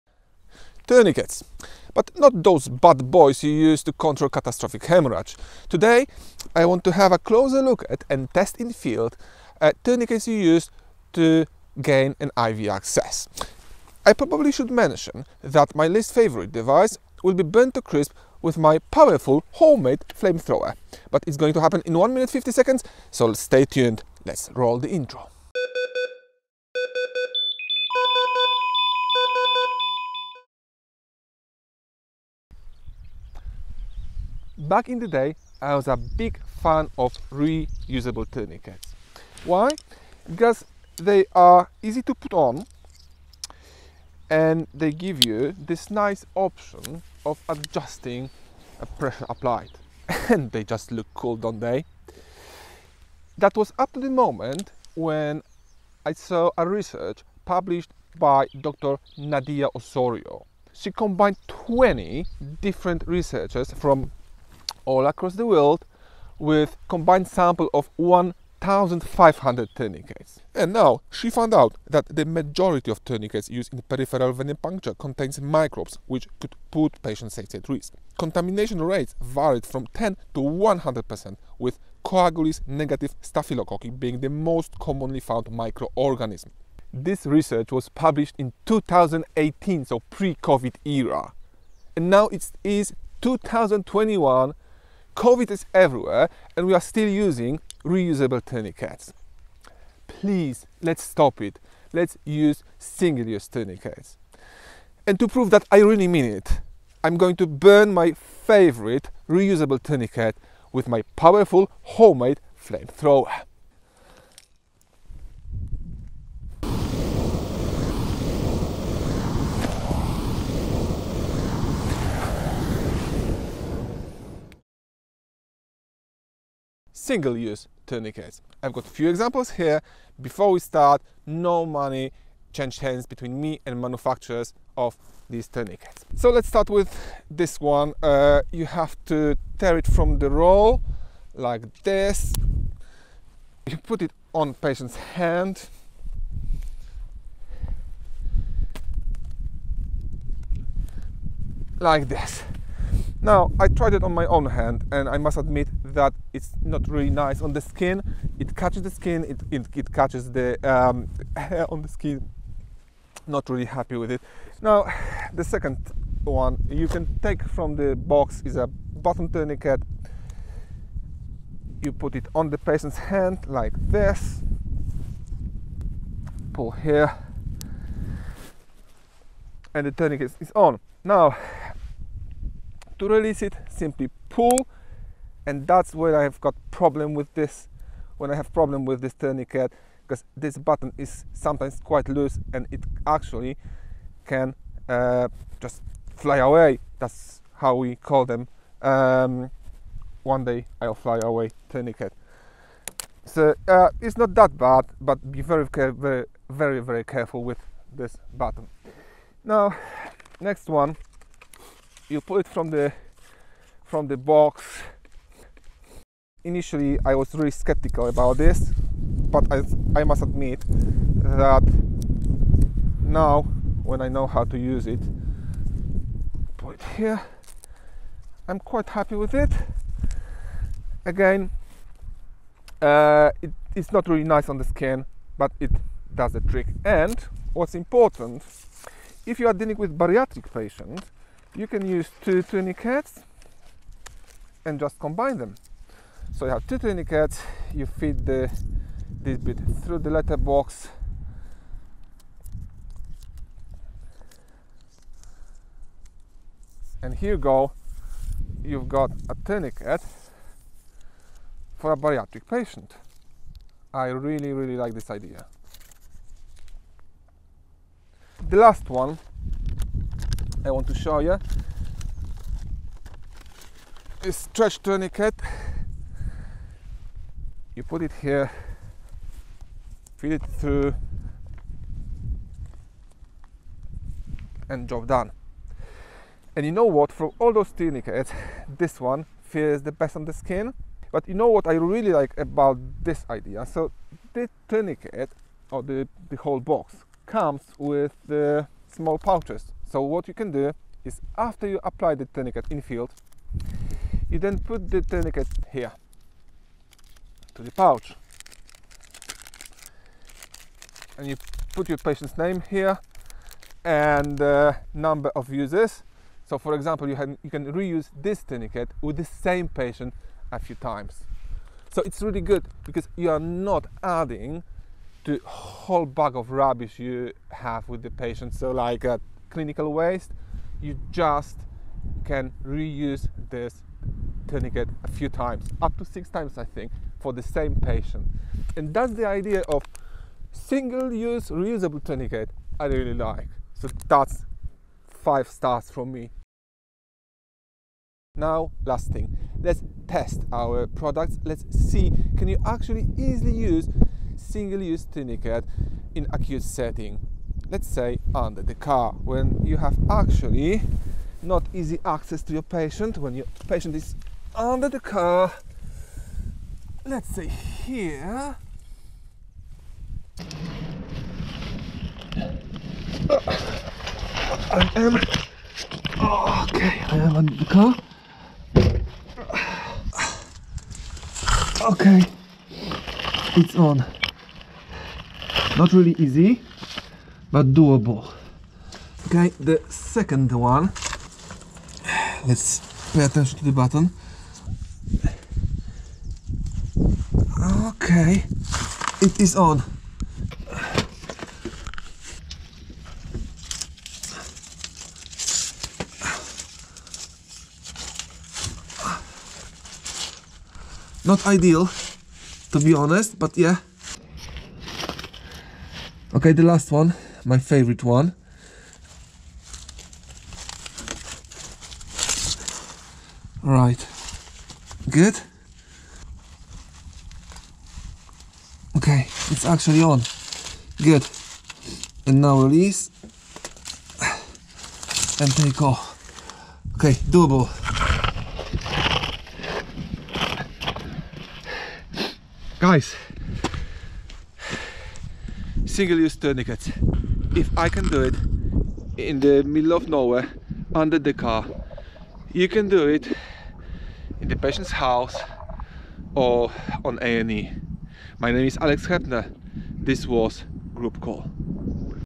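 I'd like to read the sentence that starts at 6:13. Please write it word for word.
Uh, I am, okay, I am under the car.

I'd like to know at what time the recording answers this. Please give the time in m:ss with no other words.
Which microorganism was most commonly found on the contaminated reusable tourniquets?
1:22.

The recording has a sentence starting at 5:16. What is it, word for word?
So for example, you, have, you can reuse this tourniquet with the same patient a few times.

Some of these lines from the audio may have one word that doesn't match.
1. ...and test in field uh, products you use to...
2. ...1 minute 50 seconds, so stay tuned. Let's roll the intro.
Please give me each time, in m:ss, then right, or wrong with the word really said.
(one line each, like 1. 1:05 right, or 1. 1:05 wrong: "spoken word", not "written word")
1. 0:08 wrong: "tourniquets", not "products"
2. 0:21 right.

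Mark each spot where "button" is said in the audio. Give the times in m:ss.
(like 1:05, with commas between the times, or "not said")
2:48, 3:10, 3:28, 6:33.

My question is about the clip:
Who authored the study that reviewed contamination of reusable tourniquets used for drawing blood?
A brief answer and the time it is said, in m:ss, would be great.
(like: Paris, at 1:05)
Dr. Nadia Osorio, at 0:58.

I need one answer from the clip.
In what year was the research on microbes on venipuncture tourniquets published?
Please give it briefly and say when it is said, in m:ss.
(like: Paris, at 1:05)
2018, at 1:28.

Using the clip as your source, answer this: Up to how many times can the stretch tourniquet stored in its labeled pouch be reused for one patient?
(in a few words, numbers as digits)
6.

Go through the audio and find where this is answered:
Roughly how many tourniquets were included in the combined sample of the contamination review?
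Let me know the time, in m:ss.
1:07.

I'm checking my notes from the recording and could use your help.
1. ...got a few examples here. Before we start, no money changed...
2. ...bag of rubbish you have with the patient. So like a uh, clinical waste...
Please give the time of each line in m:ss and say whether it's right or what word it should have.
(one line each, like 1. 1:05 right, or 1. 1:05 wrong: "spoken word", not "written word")
1. 2:08 right
2. 5:26 right.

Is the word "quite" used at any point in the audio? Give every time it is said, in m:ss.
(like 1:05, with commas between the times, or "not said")
3:11, 3:48.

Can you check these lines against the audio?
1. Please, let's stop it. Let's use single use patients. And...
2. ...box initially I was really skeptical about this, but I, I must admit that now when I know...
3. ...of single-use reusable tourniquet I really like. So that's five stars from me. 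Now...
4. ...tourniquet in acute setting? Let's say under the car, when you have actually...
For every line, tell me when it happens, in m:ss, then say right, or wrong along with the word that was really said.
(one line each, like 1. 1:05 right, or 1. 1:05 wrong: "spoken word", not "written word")
1. 1:40 wrong: "tourniquets", not "patients"
2. 3:34 right
3. 5:39 right
4. 5:55 right.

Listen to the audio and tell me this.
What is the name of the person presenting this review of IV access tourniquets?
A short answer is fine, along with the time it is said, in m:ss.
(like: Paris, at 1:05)
Alex Hepner, at 7:38.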